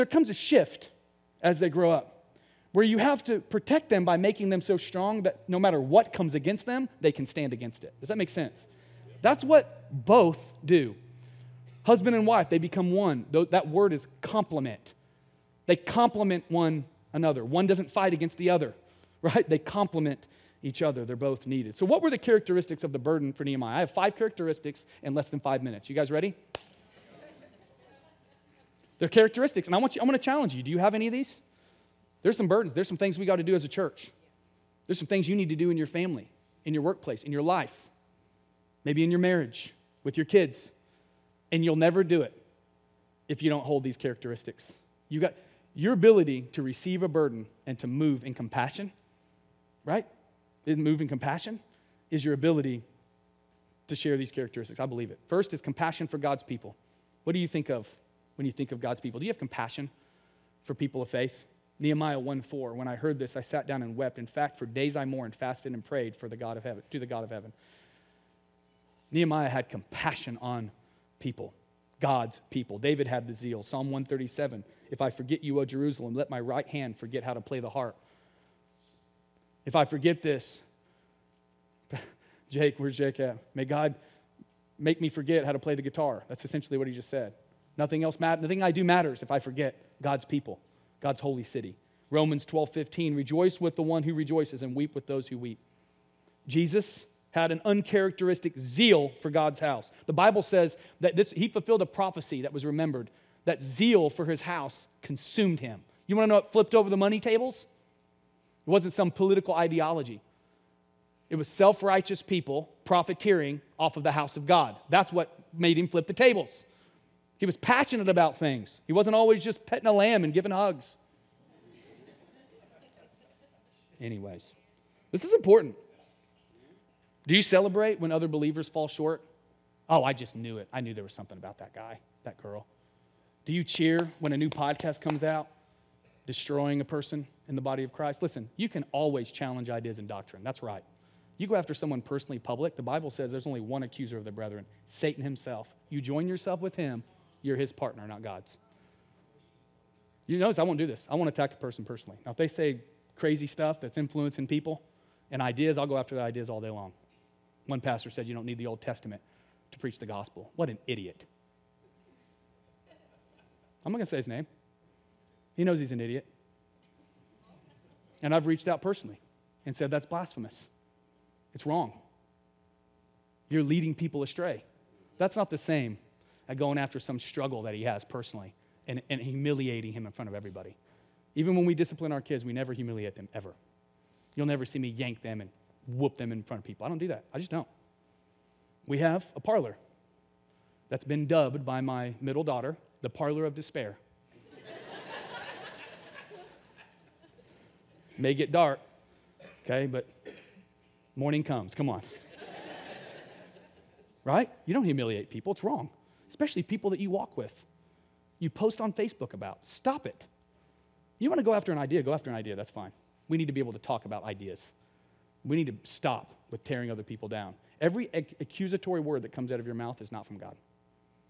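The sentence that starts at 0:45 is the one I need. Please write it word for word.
You got your ability to receive a burden and to move in compassion, right?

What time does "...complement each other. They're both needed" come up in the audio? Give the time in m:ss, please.
0:19.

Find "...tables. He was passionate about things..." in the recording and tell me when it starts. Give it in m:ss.
1:56.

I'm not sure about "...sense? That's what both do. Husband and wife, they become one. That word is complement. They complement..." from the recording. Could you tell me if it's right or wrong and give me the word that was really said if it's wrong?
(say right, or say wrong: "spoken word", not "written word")
right.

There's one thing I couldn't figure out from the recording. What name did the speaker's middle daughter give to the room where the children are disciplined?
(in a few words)
the parlor of despair.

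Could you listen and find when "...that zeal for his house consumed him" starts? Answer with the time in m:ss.
1:43.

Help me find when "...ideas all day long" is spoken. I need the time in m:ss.
2:36.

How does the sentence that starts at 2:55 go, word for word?
That's not the same as going after some struggle that he has personally and, and humiliating him in front of everybody.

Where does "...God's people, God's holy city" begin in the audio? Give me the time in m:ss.
1:30.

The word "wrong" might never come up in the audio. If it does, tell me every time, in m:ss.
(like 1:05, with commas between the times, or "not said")
2:51, 3:25.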